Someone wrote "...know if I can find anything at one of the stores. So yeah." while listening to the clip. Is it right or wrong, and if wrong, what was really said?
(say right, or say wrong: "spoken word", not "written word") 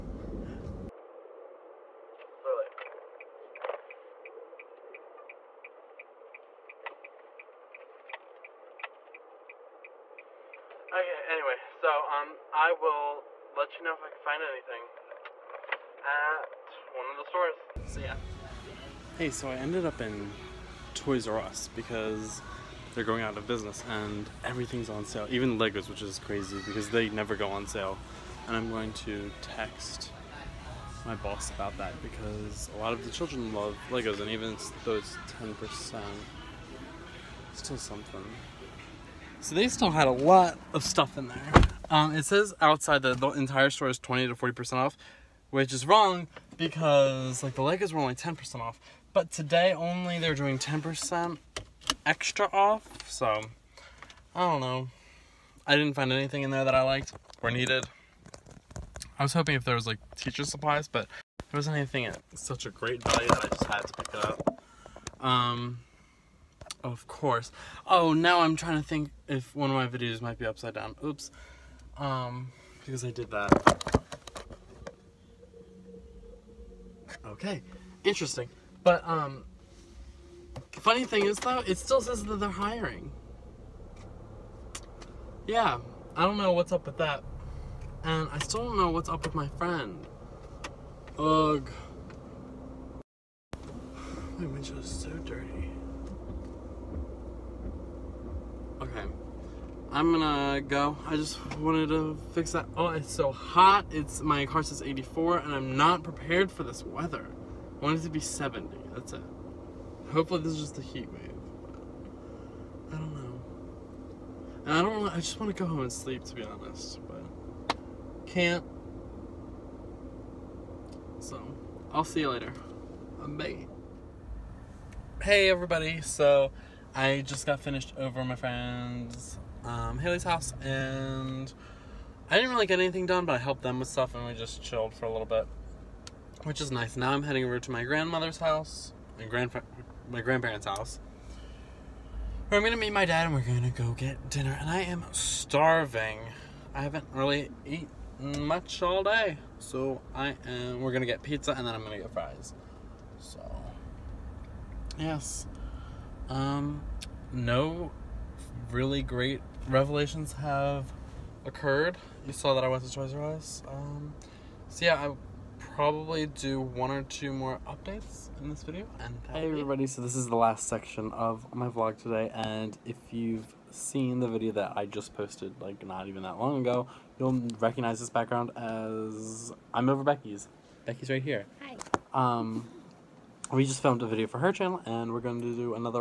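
right.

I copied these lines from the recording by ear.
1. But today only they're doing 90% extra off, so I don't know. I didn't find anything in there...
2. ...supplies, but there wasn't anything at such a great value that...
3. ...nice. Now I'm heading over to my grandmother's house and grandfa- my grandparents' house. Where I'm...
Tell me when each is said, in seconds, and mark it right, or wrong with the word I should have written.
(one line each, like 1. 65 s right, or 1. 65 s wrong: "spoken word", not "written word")
1. 49 s wrong: "10", not "90"
2. 60 s right
3. 136 s right.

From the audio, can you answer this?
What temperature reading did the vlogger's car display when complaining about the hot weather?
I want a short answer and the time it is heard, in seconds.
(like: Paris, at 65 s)
84, at 104 s.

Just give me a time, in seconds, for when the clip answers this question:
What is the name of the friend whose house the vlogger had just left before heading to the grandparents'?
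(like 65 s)
129 s.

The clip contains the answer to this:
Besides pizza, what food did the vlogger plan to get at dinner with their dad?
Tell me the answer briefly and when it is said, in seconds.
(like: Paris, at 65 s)
Fries, at 152 s.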